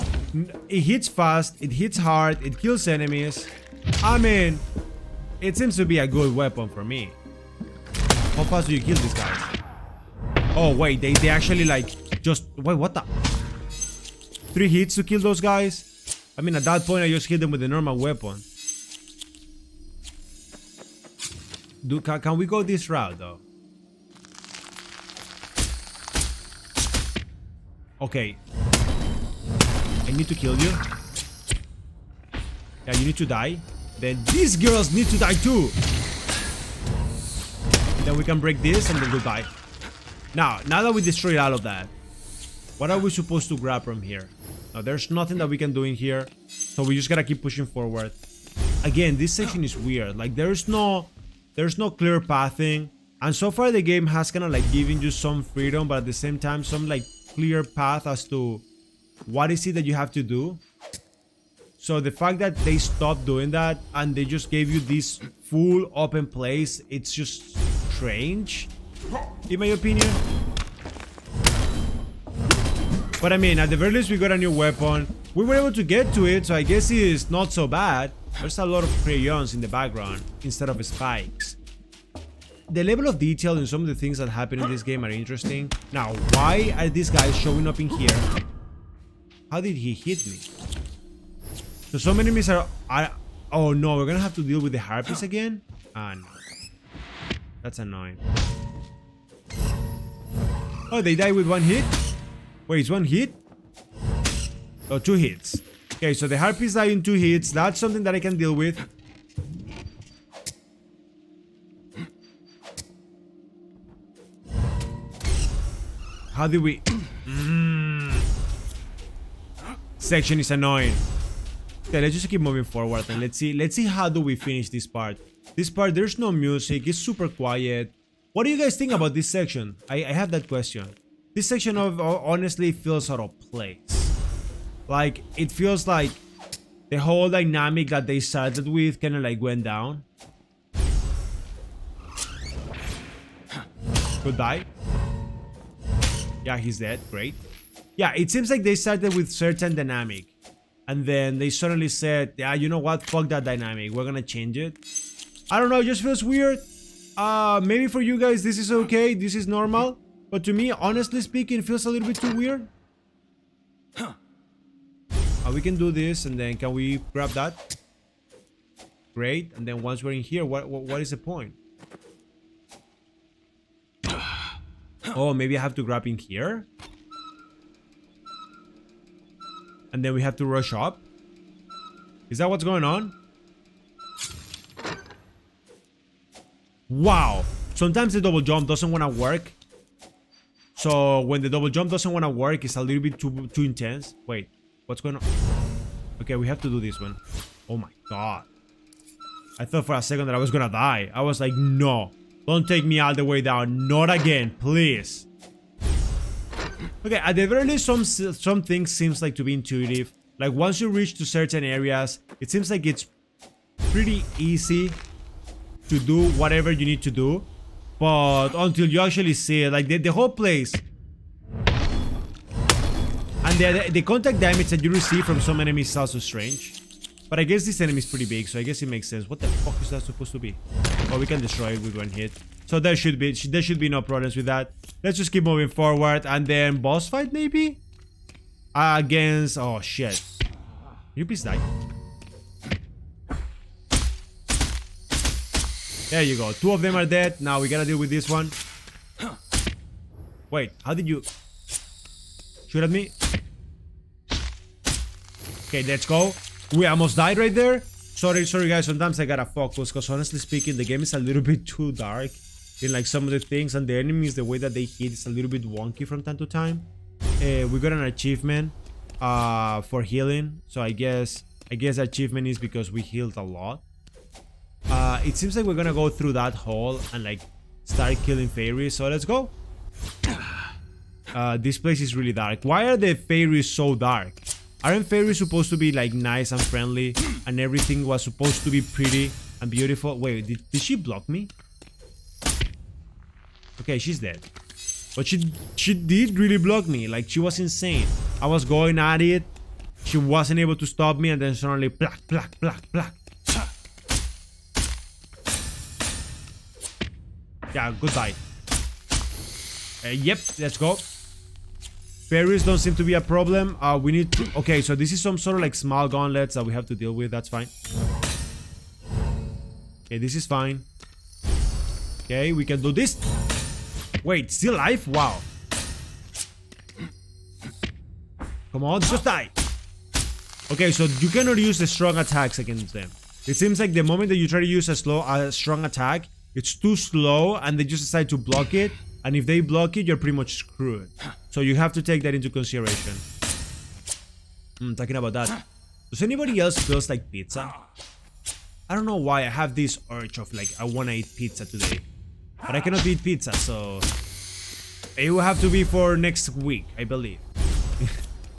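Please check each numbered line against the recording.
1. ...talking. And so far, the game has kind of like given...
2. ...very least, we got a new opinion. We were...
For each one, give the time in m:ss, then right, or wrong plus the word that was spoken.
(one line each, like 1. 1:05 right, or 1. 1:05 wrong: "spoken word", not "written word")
1. 0:52 wrong: "pathing", not "talking"
2. 1:13 wrong: "weapon", not "opinion".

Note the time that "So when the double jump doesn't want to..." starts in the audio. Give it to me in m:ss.
3:10.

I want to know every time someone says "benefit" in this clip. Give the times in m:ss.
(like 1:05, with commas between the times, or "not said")
not said.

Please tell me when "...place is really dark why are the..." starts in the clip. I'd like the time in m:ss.
4:41.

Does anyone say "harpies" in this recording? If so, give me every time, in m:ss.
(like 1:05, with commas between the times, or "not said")
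1:34, 1:46.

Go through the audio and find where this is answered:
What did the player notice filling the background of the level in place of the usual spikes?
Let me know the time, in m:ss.
1:19.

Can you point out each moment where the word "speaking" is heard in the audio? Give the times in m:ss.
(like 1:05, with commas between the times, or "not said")
2:41, 4:20.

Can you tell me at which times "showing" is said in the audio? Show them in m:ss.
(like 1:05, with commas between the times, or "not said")
1:27.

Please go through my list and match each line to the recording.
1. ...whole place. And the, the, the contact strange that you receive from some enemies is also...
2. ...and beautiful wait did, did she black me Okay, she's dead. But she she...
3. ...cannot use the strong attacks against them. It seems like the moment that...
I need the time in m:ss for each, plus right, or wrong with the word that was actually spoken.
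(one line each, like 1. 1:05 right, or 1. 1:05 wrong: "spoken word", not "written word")
1. 3:40 wrong: "damage", not "strange"
2. 4:49 wrong: "block", not "black"
3. 5:31 right.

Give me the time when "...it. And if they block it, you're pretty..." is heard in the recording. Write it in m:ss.
5:38.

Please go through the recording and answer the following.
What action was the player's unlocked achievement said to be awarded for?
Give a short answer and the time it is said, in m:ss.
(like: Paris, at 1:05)
Healing, at 4:30.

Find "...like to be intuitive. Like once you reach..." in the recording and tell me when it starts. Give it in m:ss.
3:29.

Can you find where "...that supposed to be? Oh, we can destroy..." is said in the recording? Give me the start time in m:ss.
3:49.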